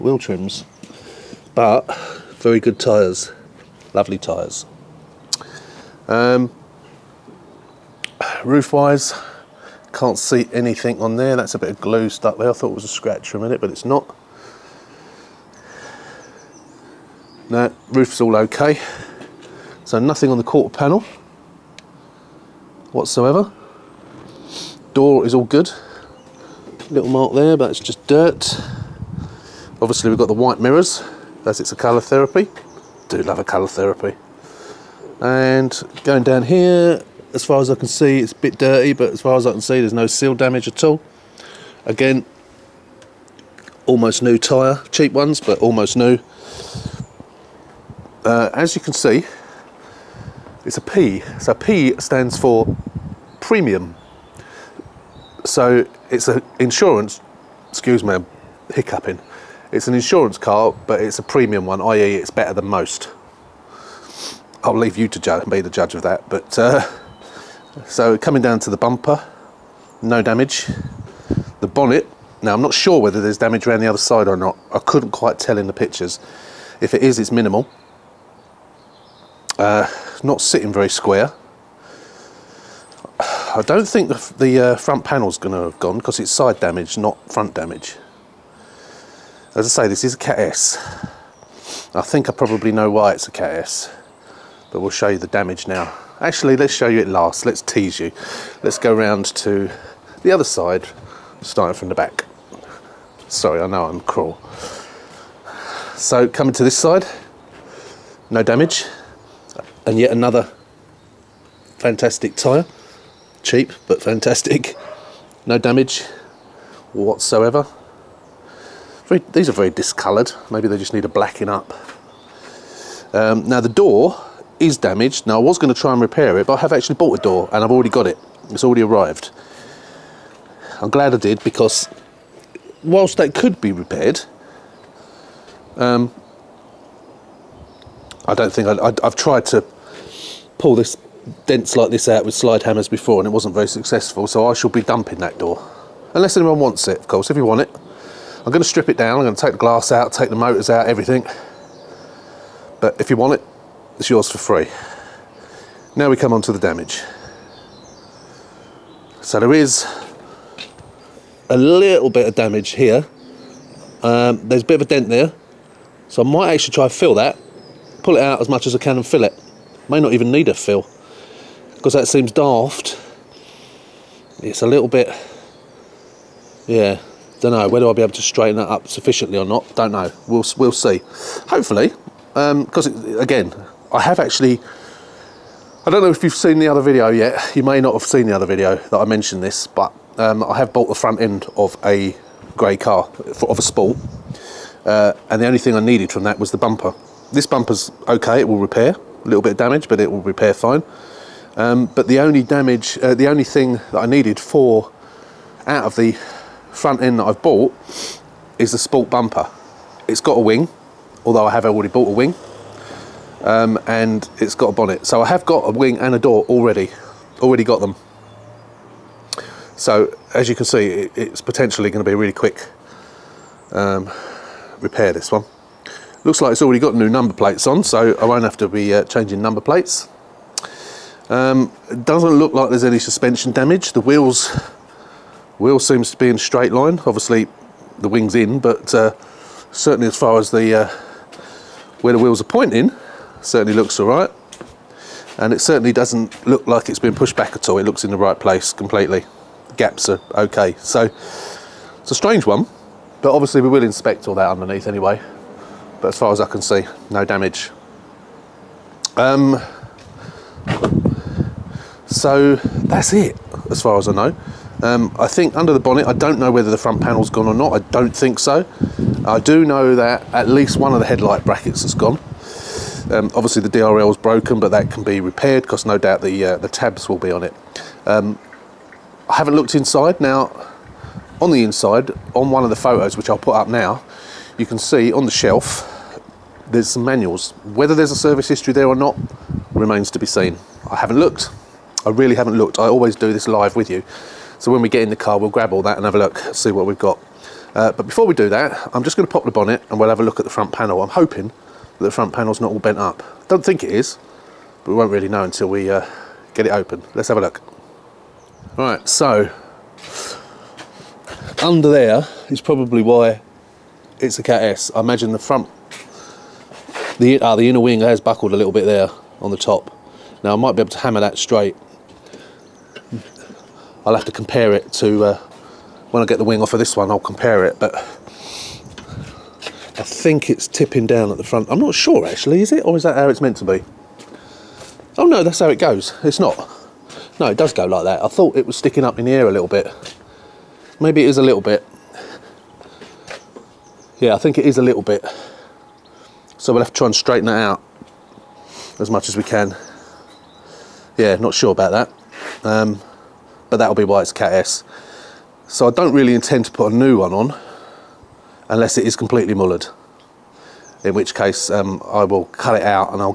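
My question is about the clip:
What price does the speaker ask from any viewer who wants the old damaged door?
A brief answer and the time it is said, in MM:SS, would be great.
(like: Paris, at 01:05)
free, at 02:34.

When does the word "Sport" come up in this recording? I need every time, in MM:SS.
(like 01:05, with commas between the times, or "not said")
03:13, 03:28.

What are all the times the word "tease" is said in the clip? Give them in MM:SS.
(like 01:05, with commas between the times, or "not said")
01:37.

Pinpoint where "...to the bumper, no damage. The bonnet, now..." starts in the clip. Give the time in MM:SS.
01:08.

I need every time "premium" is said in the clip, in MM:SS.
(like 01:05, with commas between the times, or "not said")
00:53, 01:01.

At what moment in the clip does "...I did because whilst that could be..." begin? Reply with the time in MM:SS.
02:11.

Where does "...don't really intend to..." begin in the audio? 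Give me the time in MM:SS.
05:55.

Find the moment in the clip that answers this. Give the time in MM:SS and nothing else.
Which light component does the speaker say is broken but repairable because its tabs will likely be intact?
04:33.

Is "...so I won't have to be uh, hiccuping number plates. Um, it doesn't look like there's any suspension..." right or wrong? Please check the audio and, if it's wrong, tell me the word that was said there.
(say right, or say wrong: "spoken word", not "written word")
wrong: "changing", not "hiccuping".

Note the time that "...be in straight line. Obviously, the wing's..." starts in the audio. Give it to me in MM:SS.
03:56.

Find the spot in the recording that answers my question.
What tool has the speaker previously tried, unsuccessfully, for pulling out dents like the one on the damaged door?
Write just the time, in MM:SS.
02:22.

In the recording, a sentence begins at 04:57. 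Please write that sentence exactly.
Uh, but before we do that, I'm just going to pop the bonnet and we'll have a look at the front panel.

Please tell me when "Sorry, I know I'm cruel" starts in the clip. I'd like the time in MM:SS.
01:43.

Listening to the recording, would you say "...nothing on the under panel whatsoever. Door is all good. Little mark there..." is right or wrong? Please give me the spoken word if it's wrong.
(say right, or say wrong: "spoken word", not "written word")
wrong: "quarter", not "under".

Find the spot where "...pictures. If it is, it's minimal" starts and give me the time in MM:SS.
01:15.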